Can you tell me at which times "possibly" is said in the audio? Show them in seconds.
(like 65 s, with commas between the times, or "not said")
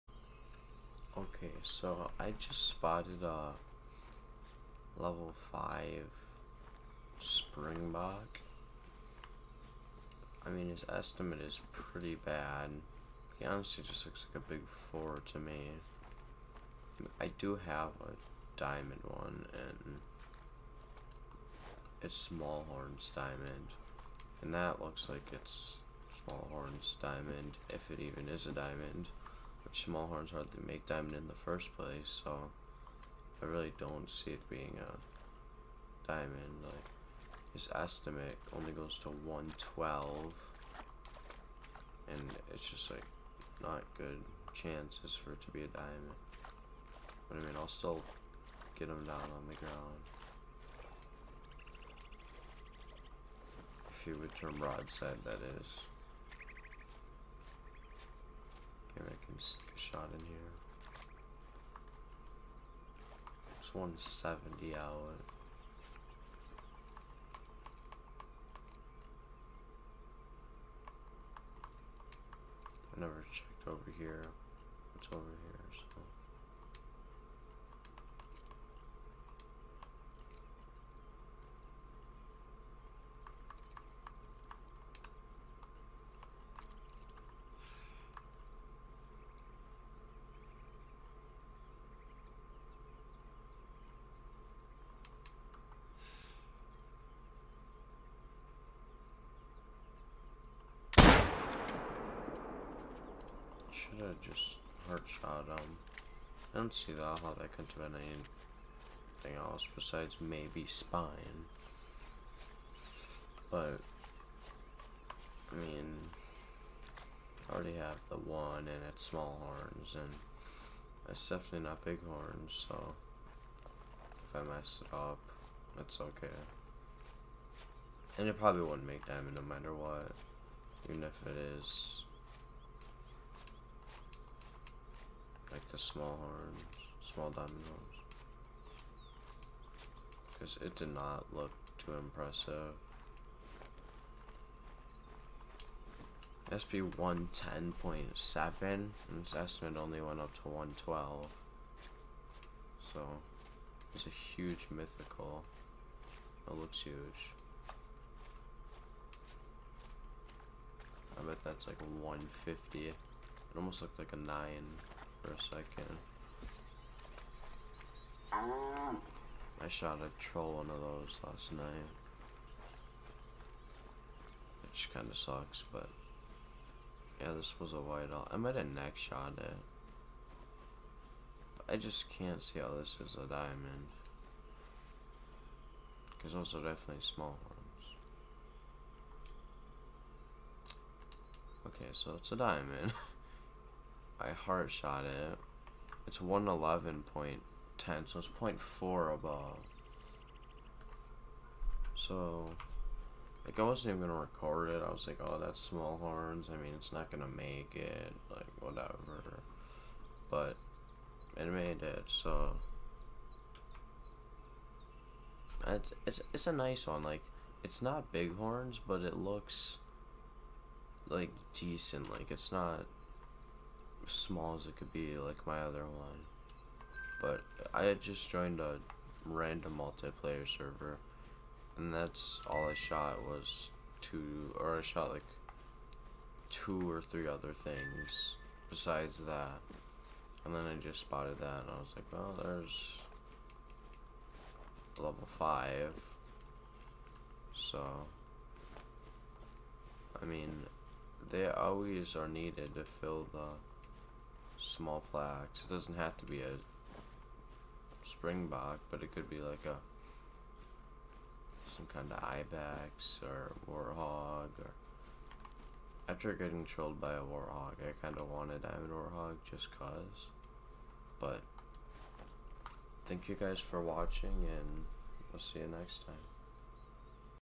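not said.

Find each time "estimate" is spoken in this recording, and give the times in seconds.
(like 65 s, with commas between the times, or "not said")
10 s, 37 s, 149 s.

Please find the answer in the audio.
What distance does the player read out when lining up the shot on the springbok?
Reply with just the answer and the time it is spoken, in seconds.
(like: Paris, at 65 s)
170, at 63 s.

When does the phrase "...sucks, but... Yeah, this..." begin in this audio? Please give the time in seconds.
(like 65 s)
175 s.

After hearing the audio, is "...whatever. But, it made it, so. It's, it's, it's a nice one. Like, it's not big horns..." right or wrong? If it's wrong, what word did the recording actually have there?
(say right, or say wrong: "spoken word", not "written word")
right.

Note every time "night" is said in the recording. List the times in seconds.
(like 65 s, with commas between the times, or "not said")
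171 s.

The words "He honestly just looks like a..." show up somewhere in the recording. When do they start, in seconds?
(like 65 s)
13 s.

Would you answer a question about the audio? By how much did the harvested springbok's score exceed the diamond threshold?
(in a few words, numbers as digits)
0.4.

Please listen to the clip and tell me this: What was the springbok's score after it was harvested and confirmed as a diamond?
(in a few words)
111.10.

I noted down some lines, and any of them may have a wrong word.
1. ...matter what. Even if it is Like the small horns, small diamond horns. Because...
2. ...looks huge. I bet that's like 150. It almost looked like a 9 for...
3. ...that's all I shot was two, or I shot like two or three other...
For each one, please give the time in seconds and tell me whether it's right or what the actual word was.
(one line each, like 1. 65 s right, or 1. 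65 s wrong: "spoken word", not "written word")
1. 129 s right
2. 156 s right
3. 231 s right.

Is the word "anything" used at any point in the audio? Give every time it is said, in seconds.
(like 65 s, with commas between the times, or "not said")
108 s.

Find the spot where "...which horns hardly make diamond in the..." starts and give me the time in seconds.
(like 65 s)
29 s.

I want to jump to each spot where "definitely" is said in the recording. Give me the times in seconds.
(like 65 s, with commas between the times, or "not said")
121 s, 186 s.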